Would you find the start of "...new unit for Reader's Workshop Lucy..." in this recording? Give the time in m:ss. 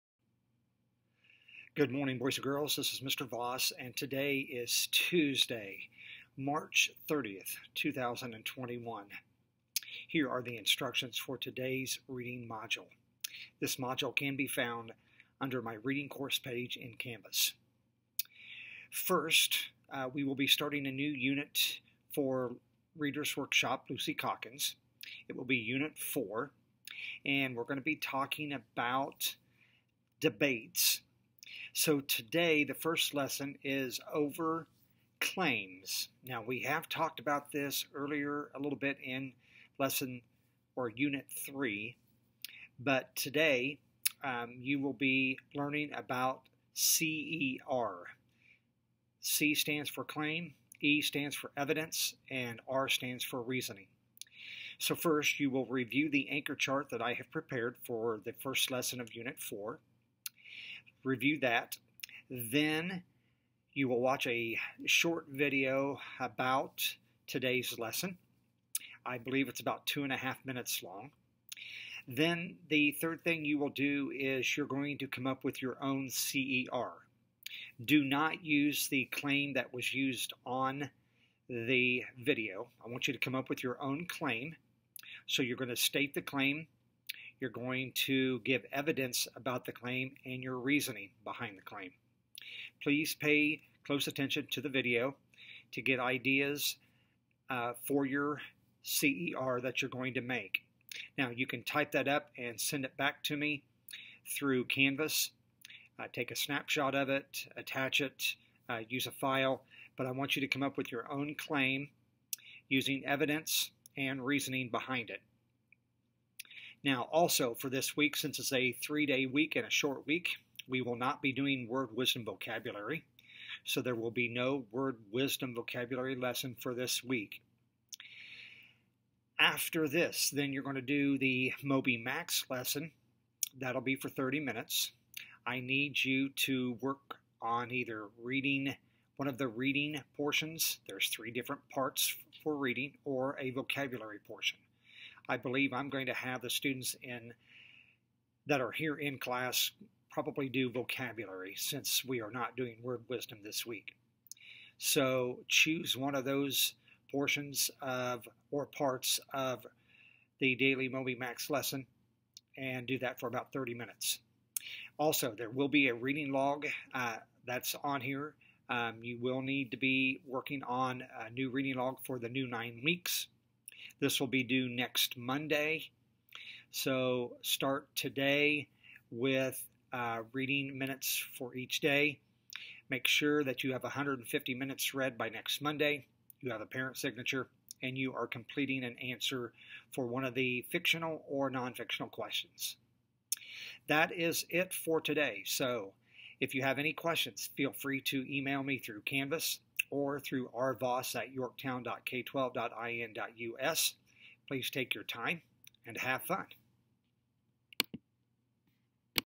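0:20.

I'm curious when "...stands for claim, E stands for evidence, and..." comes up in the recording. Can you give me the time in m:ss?
0:49.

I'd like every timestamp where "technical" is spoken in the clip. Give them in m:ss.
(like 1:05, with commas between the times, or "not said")
not said.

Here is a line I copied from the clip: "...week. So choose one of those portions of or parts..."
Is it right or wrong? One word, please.
right.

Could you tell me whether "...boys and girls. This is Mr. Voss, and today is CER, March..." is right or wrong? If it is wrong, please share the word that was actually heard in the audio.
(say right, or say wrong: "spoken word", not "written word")
wrong: "Tuesday", not "CER".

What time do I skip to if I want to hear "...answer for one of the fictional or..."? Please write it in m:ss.
3:08.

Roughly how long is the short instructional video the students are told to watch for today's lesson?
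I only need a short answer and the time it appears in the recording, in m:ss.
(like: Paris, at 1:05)
2 and a half minutes, at 1:09.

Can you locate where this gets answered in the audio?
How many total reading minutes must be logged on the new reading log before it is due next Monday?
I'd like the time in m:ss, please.
3:03.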